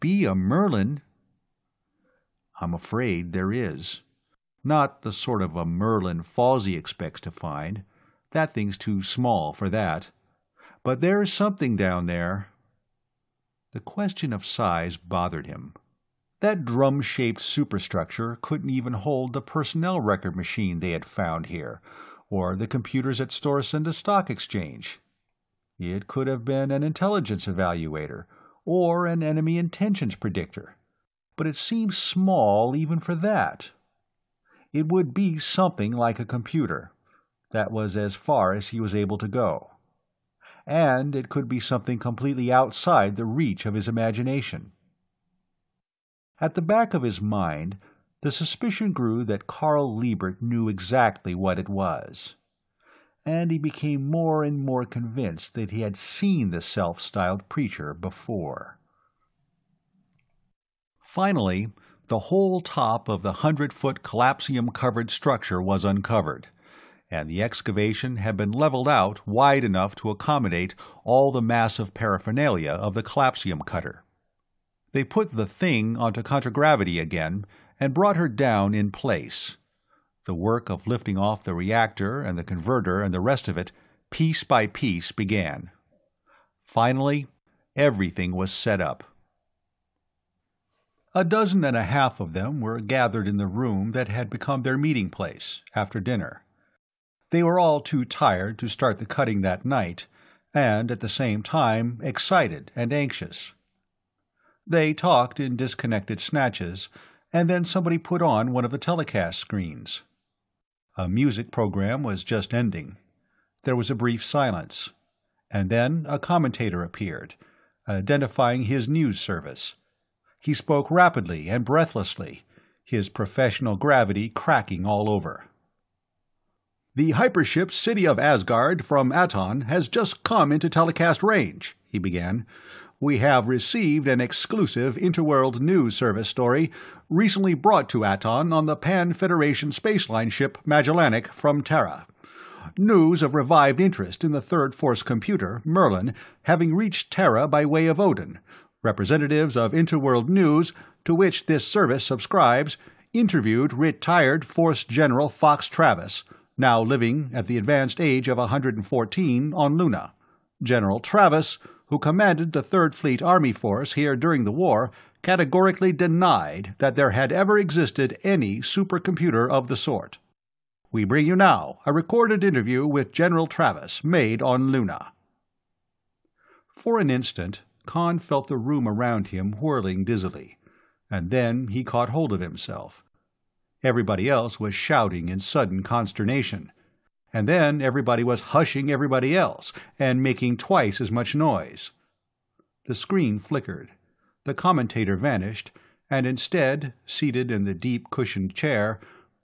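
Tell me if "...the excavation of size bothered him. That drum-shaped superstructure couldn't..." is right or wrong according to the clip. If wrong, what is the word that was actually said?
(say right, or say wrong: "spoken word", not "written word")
wrong: "question", not "excavation".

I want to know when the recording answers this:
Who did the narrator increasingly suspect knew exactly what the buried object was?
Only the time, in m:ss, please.
0:49.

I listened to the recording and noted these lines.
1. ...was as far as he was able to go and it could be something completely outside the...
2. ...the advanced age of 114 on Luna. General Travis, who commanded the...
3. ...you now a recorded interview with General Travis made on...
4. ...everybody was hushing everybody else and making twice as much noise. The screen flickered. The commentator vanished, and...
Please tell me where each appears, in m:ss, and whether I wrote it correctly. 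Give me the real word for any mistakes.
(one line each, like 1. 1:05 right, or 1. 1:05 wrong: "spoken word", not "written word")
1. 0:37 right
2. 2:37 right
3. 2:51 right
4. 3:07 right.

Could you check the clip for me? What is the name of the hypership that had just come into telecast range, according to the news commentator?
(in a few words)
City of Asgard.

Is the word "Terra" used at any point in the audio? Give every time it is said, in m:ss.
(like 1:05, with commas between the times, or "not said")
2:21, 2:27.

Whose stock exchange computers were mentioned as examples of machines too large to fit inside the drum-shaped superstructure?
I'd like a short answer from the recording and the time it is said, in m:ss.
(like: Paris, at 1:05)
Storisende, at 0:23.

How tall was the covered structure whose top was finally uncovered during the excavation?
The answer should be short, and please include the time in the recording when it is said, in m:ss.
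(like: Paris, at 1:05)
100 feet, at 1:03.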